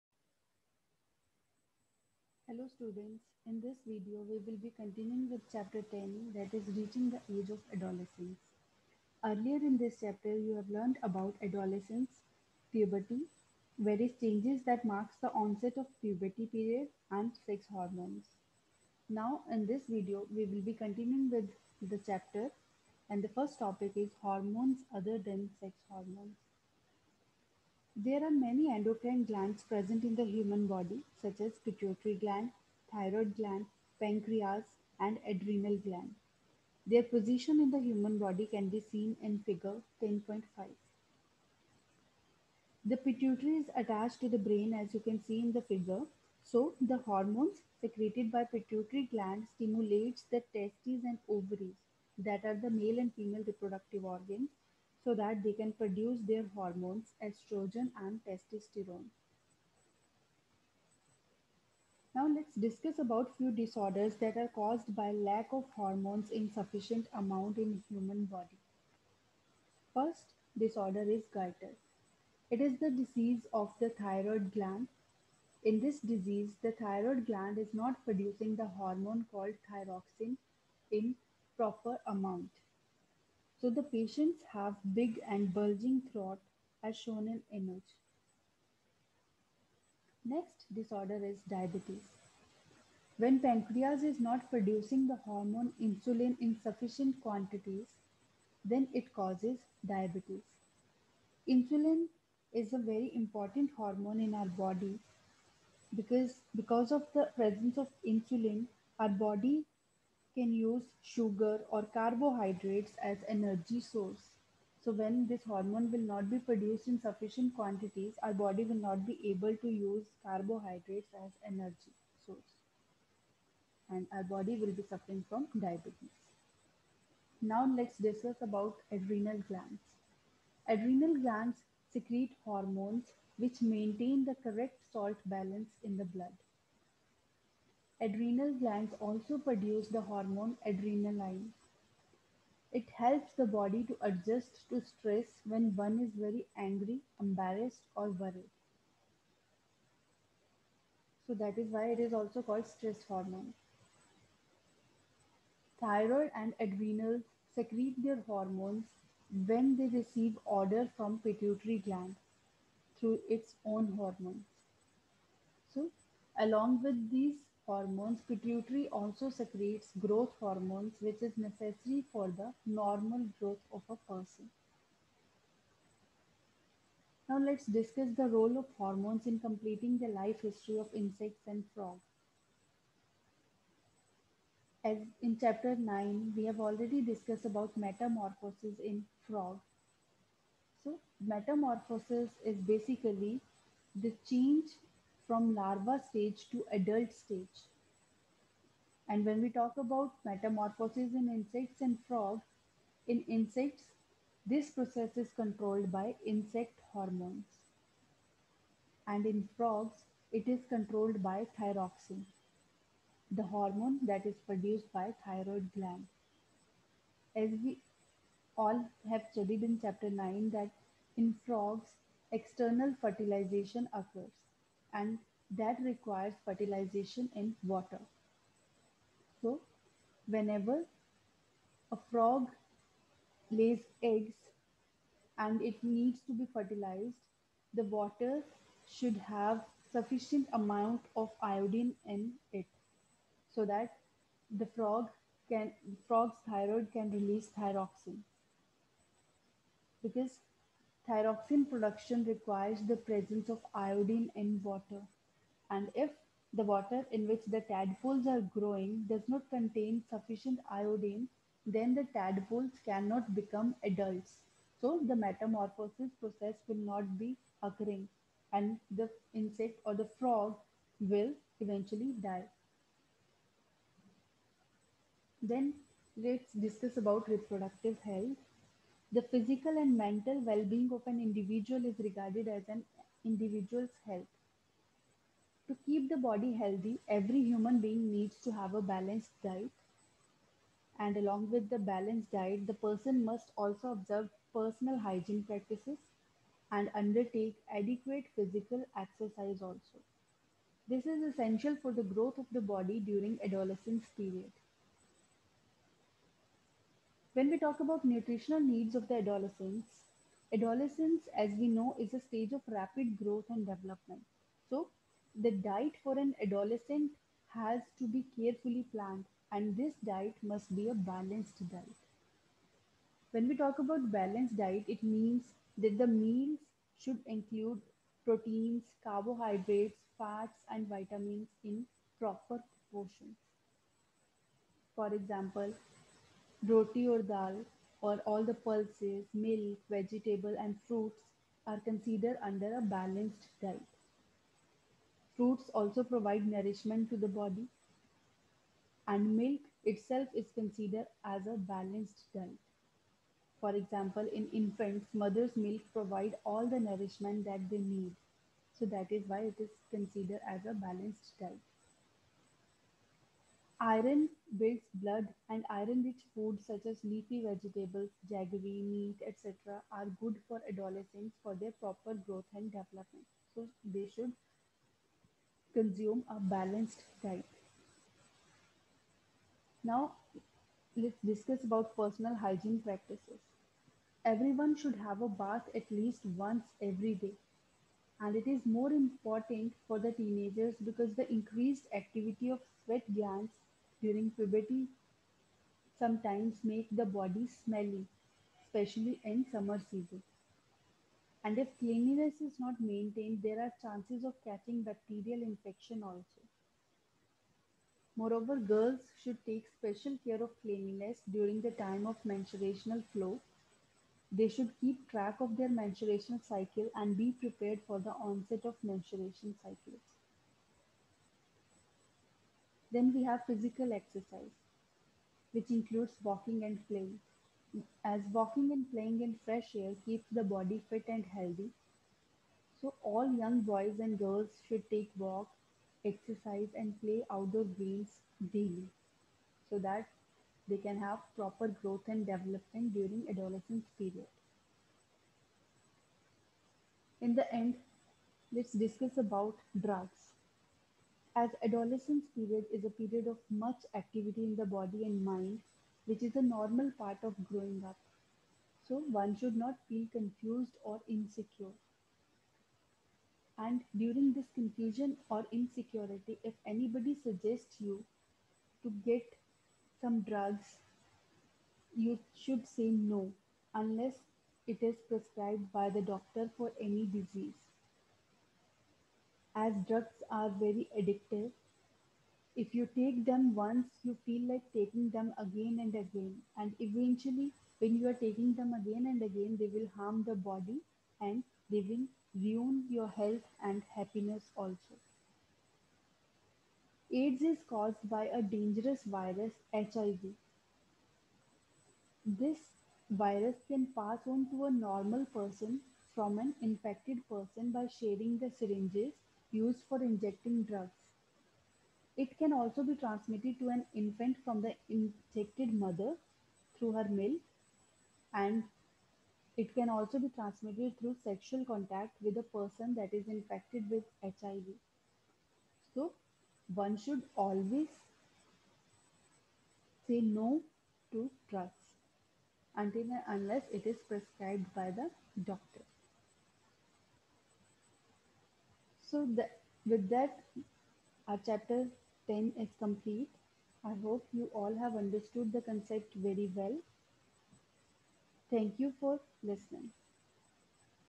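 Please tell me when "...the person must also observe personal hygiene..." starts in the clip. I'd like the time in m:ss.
4:52.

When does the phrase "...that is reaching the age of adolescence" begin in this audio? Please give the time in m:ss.
0:06.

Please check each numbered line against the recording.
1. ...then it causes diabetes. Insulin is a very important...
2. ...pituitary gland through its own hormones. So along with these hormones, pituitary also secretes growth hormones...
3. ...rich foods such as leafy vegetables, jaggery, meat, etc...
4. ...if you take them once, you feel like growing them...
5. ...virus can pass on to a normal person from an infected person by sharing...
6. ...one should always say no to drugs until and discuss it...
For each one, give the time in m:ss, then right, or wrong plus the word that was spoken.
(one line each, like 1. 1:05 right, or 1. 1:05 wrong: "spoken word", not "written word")
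1. 1:38 right
2. 2:41 right
3. 6:06 right
4. 8:02 wrong: "taking", not "growing"
5. 8:23 right
6. 8:46 wrong: "unless", not "discuss".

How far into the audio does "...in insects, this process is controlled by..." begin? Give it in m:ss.
3:23.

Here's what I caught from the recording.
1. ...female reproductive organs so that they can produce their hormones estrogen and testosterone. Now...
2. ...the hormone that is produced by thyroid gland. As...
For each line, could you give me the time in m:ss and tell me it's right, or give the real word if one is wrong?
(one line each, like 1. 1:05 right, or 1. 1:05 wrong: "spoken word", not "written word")
1. 0:53 right
2. 3:33 right.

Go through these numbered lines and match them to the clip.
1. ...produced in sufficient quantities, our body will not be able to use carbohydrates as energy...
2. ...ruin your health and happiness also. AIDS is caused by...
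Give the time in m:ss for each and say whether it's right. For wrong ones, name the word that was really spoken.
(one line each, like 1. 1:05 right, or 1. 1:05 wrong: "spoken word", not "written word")
1. 1:56 right
2. 8:12 right.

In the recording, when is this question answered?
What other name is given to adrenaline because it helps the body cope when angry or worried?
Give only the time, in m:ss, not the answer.
2:32.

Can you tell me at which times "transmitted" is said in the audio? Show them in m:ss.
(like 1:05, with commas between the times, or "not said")
8:32, 8:40.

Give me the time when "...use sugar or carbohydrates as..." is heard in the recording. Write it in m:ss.
1:50.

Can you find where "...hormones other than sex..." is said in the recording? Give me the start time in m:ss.
0:24.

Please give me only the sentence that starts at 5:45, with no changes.
Fruits also provide nourishment to the body, and milk itself is considered as a balanced diet.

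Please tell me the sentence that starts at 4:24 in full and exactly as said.
So the metamorphosis process will not be occurring and the insect or the frog will eventually die.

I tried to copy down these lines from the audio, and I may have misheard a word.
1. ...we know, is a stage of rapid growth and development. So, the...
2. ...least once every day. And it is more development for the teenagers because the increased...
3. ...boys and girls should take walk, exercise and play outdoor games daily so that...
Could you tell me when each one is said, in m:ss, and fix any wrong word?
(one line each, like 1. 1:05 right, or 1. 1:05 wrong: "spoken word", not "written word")
1. 5:11 right
2. 6:25 wrong: "important", not "development"
3. 7:13 right.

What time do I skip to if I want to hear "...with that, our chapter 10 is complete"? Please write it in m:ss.
8:59.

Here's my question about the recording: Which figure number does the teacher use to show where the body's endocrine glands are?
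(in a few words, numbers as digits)
10.5.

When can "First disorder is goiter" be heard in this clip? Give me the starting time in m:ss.
1:09.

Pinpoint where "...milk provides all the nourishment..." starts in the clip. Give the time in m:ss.
5:55.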